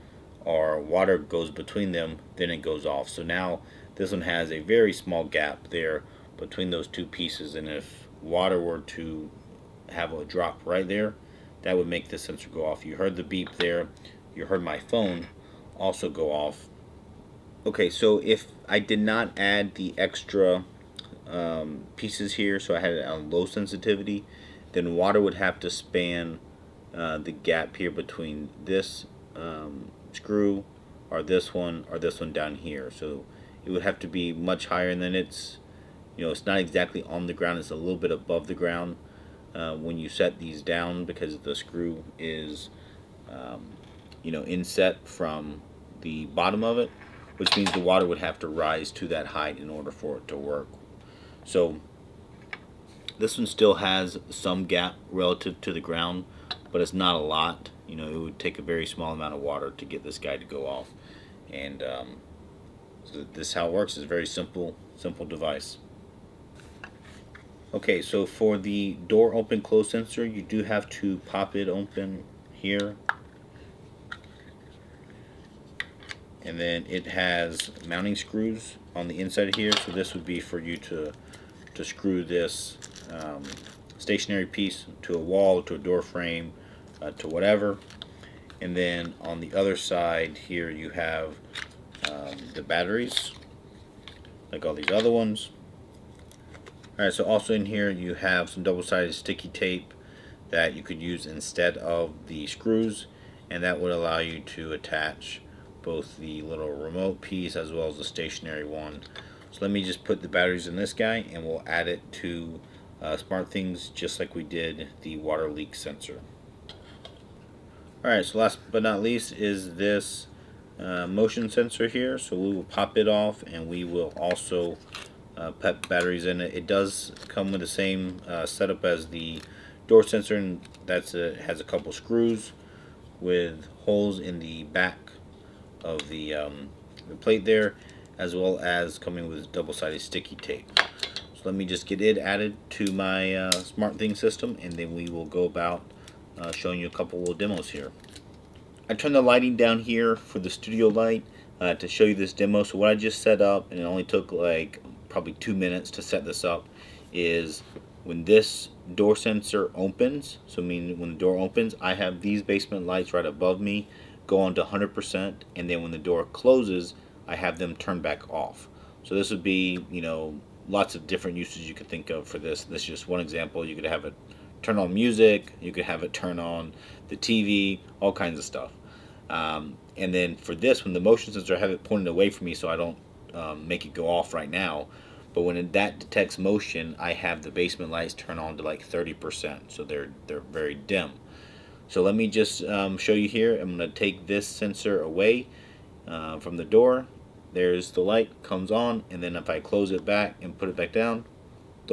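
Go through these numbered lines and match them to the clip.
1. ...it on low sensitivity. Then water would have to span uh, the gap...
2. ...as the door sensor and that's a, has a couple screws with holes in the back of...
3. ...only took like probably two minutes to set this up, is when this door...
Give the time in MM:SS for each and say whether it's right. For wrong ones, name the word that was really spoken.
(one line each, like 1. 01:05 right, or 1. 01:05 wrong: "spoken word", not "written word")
1. 00:22 right
2. 02:08 right
3. 02:33 right.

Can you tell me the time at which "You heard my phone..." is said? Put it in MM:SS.
00:14.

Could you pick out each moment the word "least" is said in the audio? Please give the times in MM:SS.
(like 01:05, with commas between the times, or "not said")
01:59.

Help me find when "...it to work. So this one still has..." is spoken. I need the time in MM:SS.
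00:50.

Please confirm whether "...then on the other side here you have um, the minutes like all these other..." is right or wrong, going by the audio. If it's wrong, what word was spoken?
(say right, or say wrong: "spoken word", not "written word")
wrong: "batteries", not "minutes".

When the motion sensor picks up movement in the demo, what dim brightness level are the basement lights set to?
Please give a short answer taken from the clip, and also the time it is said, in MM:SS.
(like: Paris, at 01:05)
30%, at 03:08.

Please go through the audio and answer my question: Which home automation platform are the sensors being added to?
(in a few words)
SmartThings.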